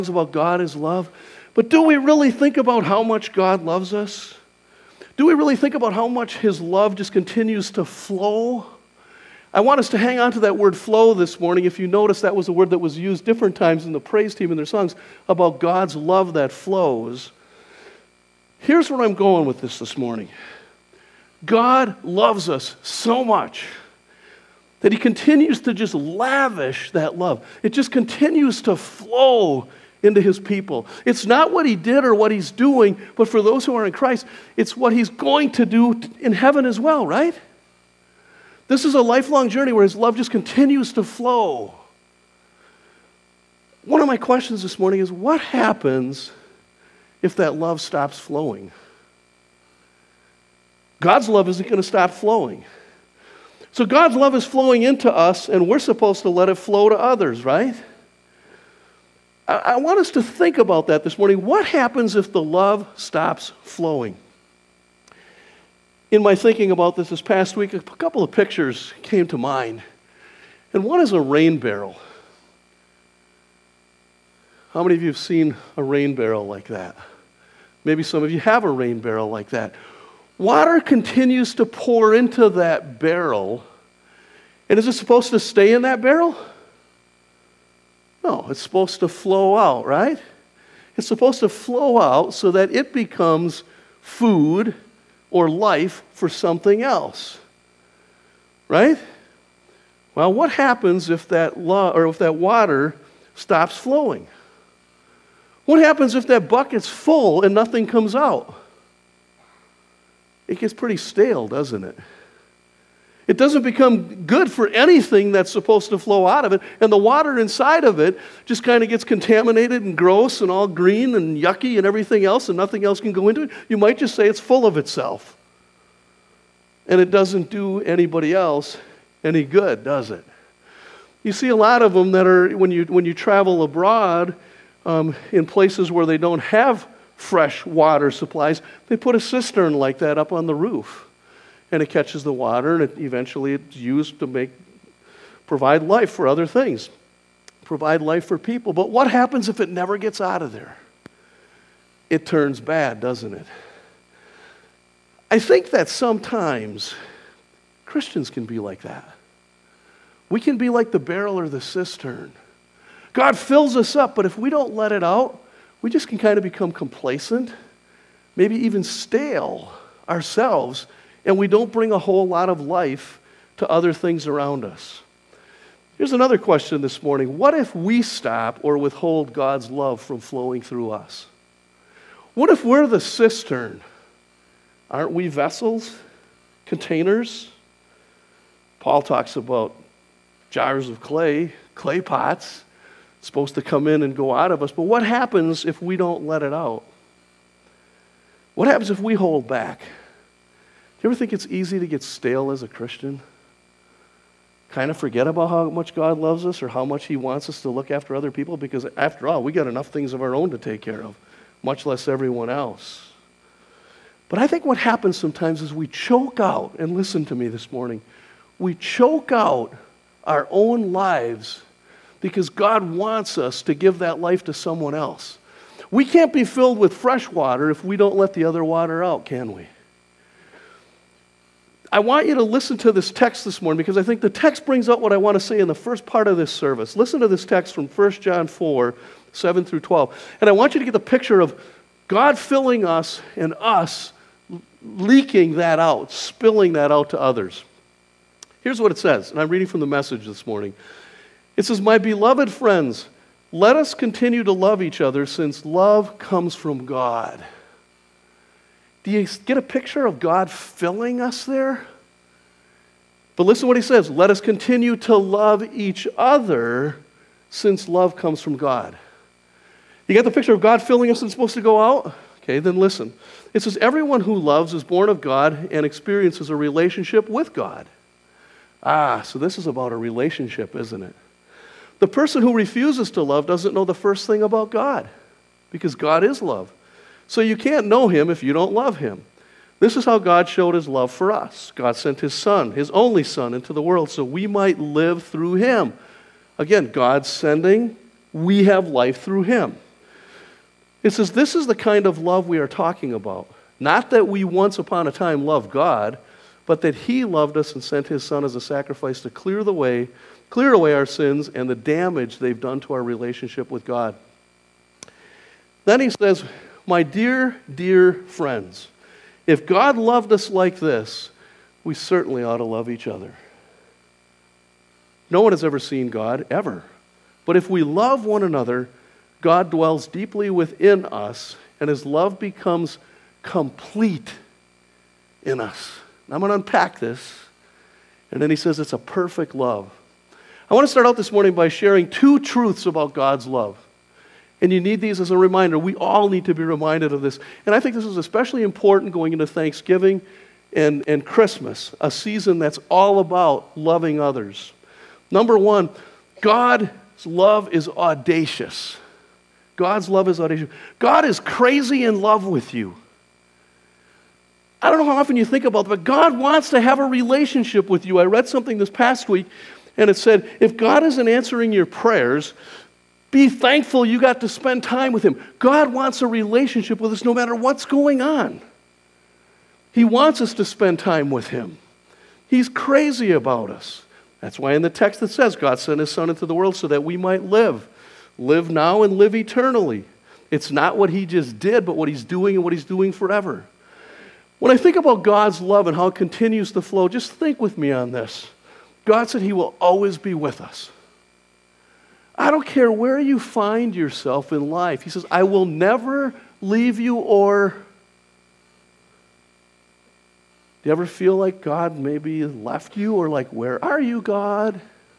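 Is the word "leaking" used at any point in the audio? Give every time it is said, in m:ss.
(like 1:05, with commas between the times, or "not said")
4:04.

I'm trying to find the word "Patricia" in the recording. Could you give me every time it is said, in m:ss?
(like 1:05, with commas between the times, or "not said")
not said.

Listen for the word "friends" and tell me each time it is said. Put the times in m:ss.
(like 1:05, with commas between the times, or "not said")
4:12, 5:18.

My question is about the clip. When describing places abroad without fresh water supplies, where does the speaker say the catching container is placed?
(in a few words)
on the roof.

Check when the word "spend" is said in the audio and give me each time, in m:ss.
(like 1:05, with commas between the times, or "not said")
6:14, 6:20.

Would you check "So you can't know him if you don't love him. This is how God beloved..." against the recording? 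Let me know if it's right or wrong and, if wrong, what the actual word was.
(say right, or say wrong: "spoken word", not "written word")
wrong: "showed", not "beloved".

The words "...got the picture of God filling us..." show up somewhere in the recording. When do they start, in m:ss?
4:30.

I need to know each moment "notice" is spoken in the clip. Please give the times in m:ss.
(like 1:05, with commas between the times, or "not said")
0:11.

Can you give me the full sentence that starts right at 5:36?
And I'm going to unpack this.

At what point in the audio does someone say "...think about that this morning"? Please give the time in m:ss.
1:00.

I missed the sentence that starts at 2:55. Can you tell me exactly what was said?
Here's another question this morning What if we stop or withhold God's love from flowing through us?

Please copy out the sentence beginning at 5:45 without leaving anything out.
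We all need to be reminded of this.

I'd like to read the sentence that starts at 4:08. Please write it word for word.
Here's what it says, and I'm reading from the message this morning.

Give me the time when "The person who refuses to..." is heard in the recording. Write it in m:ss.
4:41.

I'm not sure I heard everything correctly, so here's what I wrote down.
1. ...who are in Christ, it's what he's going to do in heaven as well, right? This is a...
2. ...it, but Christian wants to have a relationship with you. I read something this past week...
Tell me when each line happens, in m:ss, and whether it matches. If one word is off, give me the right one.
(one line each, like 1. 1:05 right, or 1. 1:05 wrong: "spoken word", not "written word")
1. 0:33 right
2. 6:05 wrong: "God", not "Christian".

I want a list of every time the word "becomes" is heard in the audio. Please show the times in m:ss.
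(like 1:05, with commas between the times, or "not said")
1:32, 1:53, 2:46, 5:32.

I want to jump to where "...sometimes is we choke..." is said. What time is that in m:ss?
3:35.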